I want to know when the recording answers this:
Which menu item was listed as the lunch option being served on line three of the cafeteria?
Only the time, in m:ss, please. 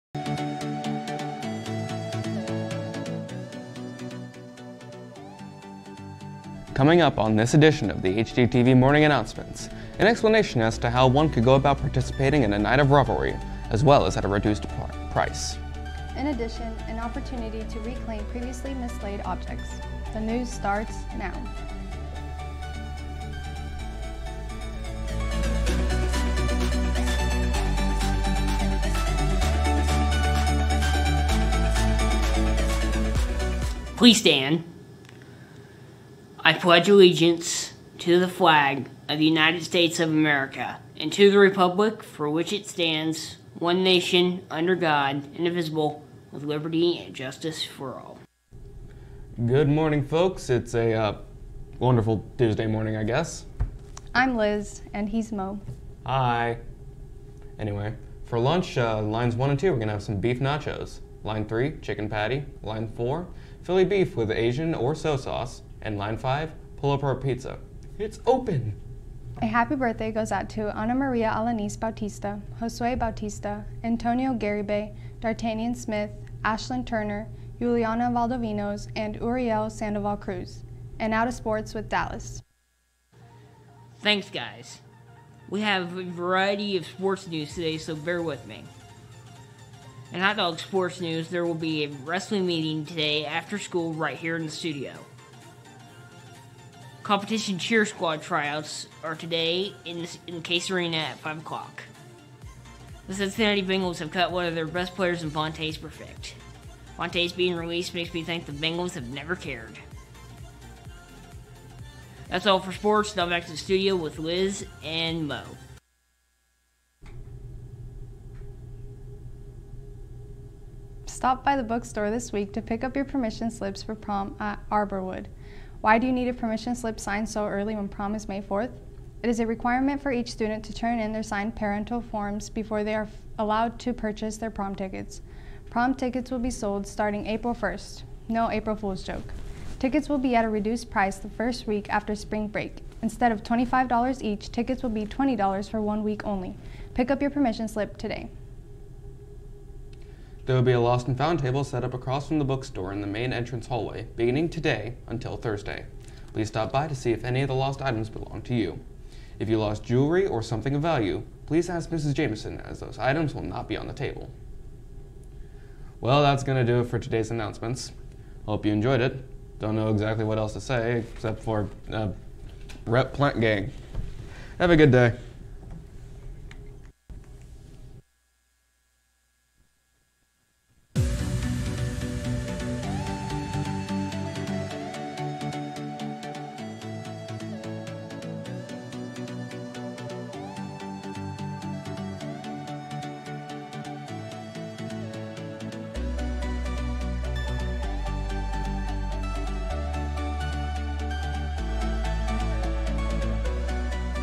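1:01.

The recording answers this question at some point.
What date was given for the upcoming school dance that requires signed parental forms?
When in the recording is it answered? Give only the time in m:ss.
2:08.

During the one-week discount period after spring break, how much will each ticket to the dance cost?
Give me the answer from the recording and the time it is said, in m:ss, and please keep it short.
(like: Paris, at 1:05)
$20, at 2:25.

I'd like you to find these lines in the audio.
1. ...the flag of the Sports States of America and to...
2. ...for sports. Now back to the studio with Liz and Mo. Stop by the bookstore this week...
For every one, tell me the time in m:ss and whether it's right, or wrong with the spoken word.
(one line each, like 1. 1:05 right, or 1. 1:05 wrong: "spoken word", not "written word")
1. 0:38 wrong: "United", not "Sports"
2. 1:52 right.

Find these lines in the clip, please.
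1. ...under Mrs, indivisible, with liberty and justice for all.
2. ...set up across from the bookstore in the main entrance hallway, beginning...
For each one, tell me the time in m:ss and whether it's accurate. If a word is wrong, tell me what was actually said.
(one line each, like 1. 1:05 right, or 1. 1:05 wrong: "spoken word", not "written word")
1. 0:44 wrong: "God", not "Mrs"
2. 2:31 right.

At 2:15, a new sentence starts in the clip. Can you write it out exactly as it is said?
Prom tickets will be sold starting April 1st.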